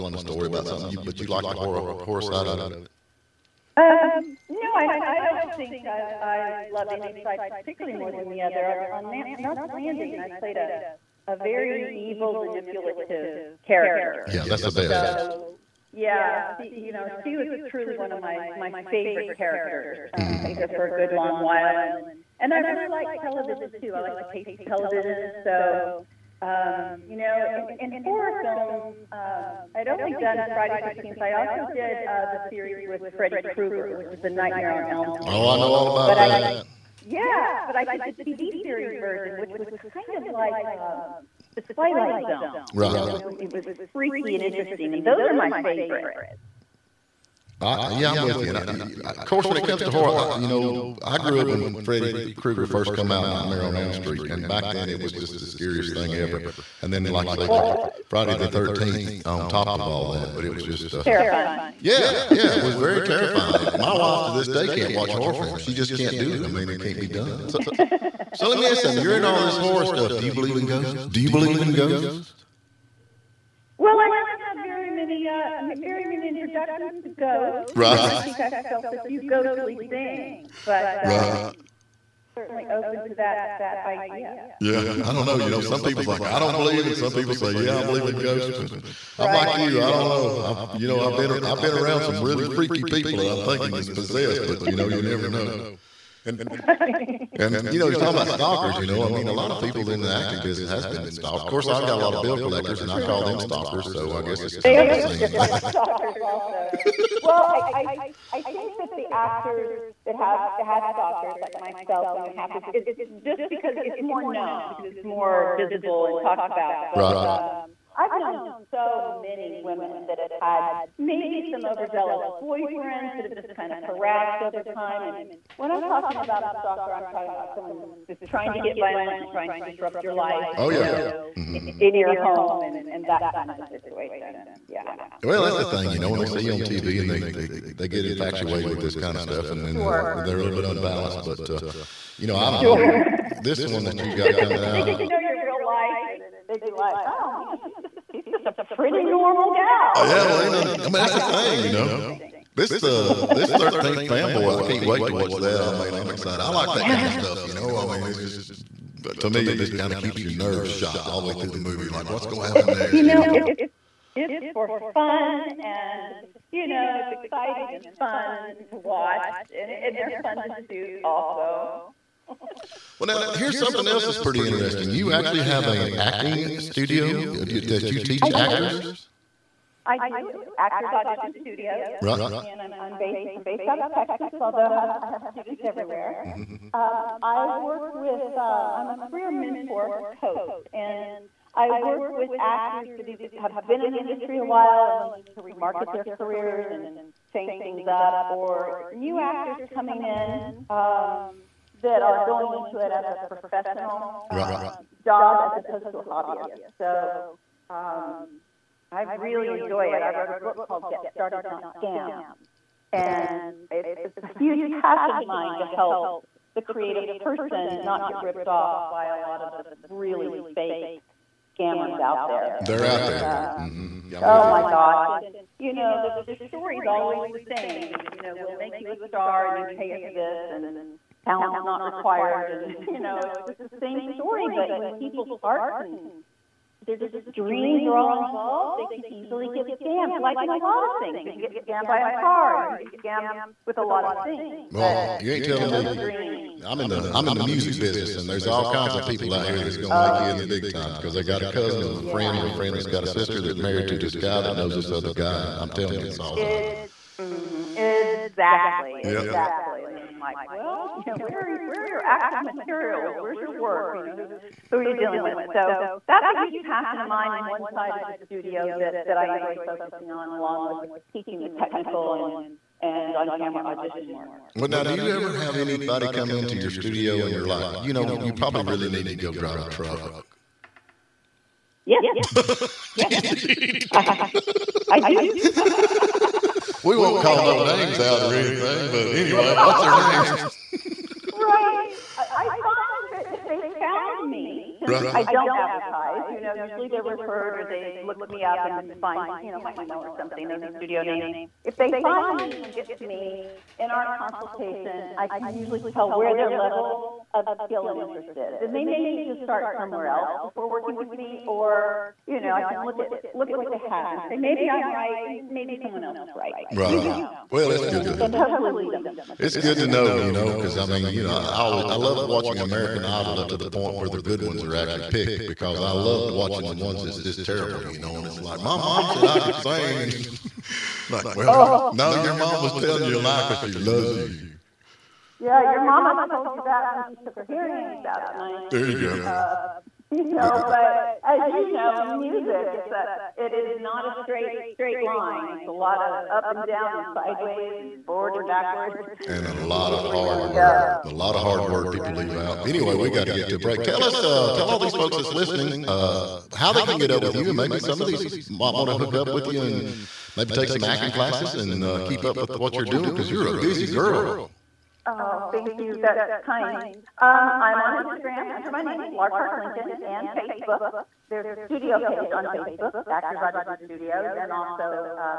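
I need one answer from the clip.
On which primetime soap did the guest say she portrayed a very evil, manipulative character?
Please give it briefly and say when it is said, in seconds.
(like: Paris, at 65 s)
Knots Landing, at 9 s.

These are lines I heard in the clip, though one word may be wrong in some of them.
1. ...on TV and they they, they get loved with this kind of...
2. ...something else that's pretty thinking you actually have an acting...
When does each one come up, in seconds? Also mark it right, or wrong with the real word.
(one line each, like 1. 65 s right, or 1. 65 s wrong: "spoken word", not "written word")
1. 136 s wrong: "infatuated", not "loved"
2. 173 s wrong: "interesting", not "thinking".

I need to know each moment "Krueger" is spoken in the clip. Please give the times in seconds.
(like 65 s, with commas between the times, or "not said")
33 s, 52 s.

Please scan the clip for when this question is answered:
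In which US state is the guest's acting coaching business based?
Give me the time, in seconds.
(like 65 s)
183 s.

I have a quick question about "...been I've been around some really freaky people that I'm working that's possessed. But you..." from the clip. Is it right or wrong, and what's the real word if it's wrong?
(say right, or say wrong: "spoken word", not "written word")
wrong: "thinking", not "working".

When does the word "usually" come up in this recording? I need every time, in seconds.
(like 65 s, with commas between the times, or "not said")
296 s, 305 s.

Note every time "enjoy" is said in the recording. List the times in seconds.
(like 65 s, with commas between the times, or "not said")
209 s, 269 s.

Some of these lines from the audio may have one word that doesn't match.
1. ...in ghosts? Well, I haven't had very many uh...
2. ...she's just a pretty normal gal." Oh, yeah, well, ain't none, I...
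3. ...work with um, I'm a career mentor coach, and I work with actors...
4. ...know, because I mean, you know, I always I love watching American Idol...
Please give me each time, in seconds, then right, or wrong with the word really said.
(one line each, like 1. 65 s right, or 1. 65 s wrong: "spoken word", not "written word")
1. 71 s right
2. 148 s right
3. 187 s right
4. 320 s right.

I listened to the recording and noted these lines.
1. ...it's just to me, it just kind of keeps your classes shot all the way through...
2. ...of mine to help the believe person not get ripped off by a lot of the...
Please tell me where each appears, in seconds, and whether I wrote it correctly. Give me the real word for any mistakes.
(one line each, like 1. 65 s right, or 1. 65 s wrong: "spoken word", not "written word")
1. 158 s wrong: "nerves", not "classes"
2. 215 s wrong: "creative", not "believe".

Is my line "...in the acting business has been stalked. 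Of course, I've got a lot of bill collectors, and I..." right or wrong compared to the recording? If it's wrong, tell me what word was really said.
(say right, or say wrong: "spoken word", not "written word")
right.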